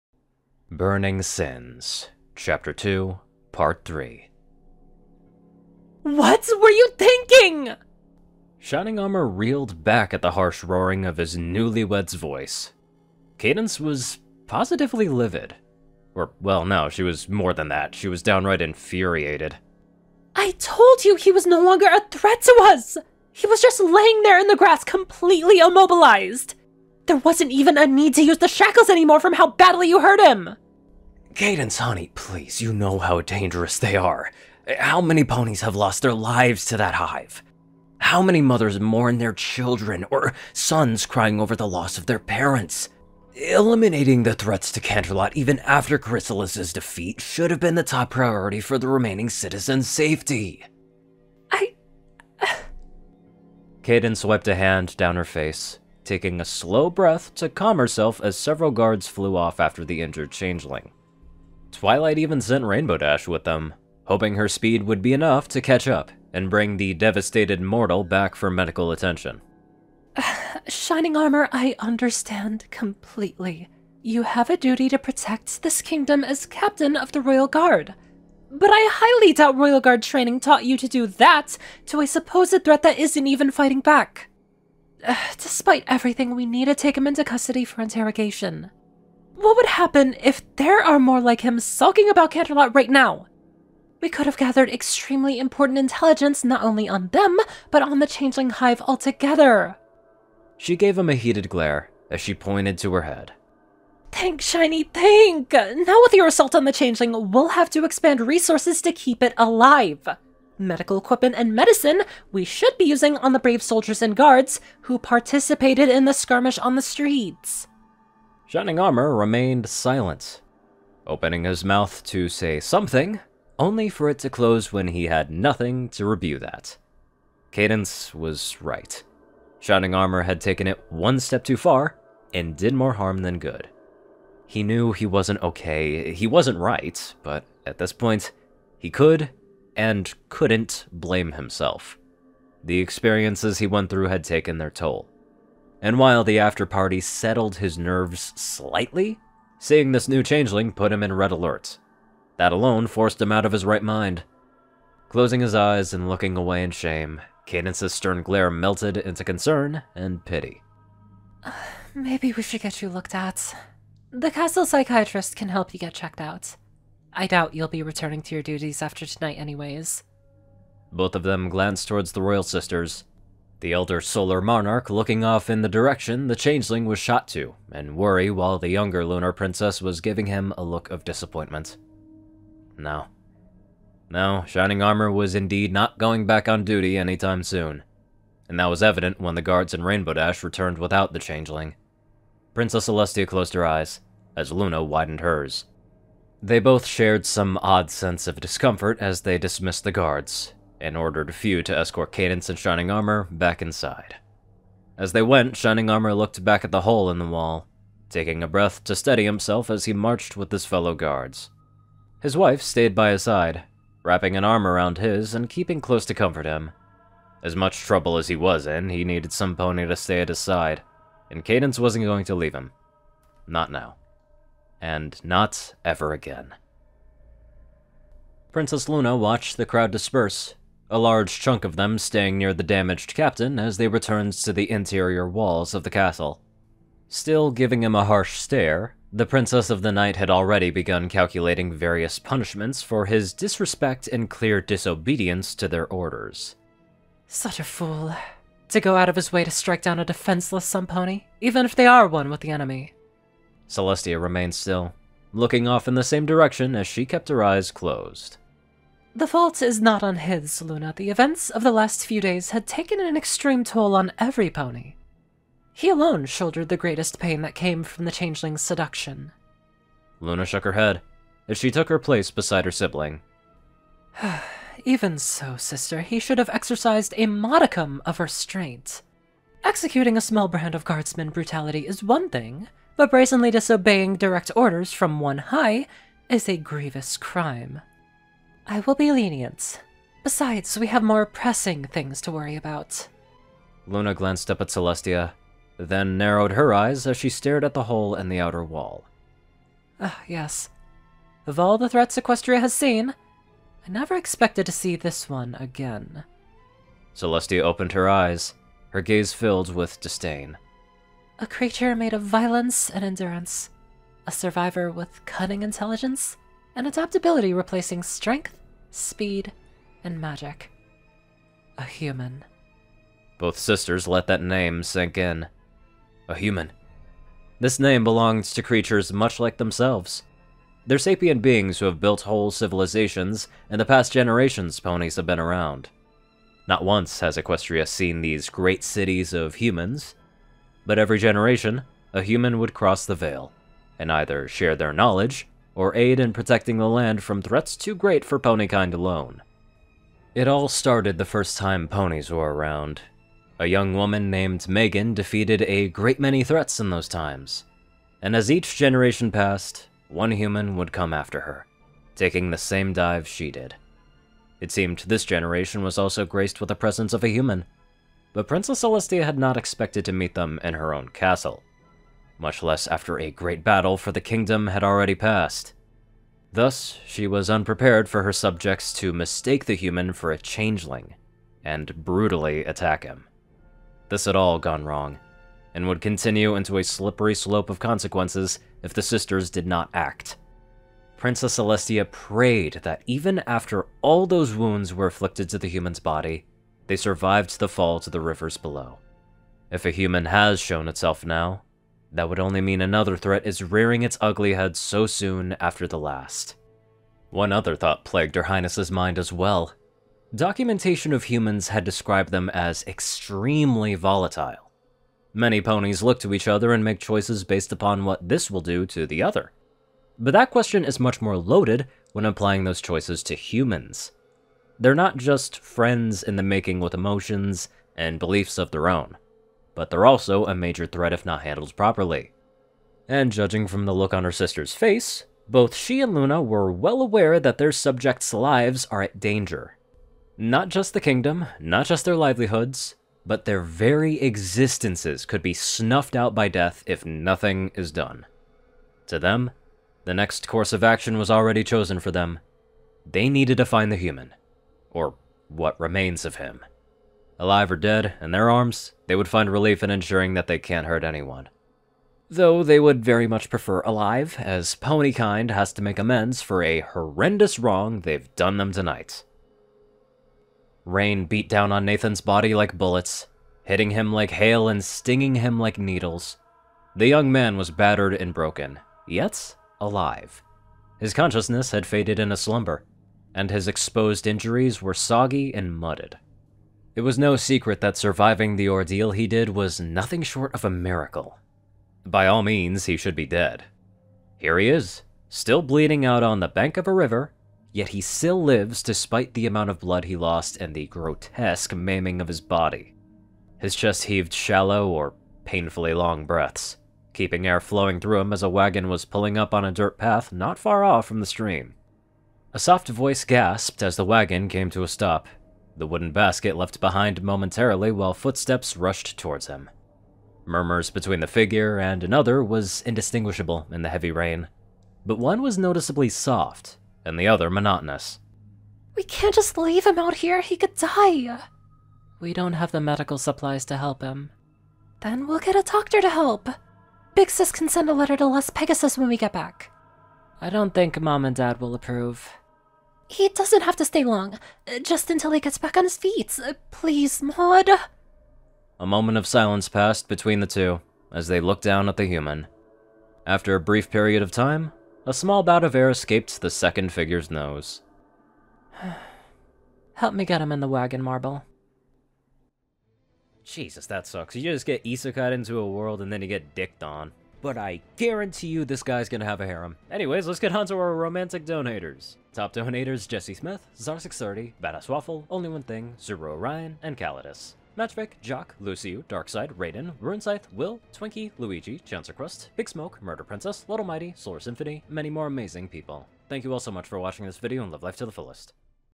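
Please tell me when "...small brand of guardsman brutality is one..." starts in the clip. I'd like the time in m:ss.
4:40.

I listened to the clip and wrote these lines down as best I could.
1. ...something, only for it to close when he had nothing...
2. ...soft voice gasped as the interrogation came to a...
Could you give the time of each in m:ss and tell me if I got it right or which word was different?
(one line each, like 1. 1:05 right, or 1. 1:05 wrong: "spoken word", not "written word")
1. 2:02 right
2. 8:32 wrong: "wagon", not "interrogation".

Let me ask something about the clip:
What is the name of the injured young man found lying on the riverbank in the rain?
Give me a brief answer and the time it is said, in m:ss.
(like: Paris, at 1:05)
Nathan, at 7:51.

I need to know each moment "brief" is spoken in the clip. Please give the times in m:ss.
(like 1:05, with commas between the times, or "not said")
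9:13.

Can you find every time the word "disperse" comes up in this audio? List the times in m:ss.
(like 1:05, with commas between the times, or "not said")
3:49.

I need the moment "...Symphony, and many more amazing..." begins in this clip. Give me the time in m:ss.
9:44.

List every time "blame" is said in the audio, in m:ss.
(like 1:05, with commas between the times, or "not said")
2:20.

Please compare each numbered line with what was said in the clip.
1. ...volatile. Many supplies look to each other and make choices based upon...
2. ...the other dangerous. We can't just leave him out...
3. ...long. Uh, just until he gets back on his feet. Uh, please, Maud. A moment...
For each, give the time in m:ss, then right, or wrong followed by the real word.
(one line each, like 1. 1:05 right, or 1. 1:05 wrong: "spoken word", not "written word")
1. 6:53 wrong: "ponies", not "supplies"
2. 8:47 wrong: "monotonous", not "dangerous"
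3. 9:04 right.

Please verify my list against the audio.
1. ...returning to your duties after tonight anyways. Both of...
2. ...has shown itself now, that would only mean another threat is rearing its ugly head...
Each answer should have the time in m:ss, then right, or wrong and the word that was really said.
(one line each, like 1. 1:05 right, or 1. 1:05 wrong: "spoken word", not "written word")
1. 2:47 right
2. 6:40 right.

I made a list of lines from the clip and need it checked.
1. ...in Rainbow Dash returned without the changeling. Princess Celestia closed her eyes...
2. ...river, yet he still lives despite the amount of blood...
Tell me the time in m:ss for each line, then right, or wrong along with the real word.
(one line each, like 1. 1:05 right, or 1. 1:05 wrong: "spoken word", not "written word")
1. 3:09 right
2. 8:16 right.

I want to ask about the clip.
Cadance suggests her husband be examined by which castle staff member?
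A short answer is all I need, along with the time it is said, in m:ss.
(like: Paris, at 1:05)
The castle psychiatrist, at 2:44.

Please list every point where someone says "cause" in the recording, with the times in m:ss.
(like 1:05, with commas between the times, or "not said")
not said.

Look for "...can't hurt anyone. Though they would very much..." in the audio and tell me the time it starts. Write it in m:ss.
7:40.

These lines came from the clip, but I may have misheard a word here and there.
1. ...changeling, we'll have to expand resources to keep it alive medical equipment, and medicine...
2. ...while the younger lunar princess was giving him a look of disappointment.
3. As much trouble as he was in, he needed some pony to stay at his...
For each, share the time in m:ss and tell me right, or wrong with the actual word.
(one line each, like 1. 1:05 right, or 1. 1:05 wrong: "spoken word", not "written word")
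1. 1:46 right
2. 2:58 right
3. 3:37 right.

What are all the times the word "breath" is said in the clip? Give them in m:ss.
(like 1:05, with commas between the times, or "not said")
0:56, 3:28, 8:26.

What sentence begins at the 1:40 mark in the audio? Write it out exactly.
She gave him a heated glare as she pointed to her head.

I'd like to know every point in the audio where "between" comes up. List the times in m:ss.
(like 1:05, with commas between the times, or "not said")
8:40, 9:10.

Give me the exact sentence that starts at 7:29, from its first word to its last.
To them, the next course of action was already chosen for them.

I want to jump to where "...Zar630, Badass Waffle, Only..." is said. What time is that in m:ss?
9:33.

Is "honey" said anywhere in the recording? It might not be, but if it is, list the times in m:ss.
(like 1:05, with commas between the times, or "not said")
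0:31.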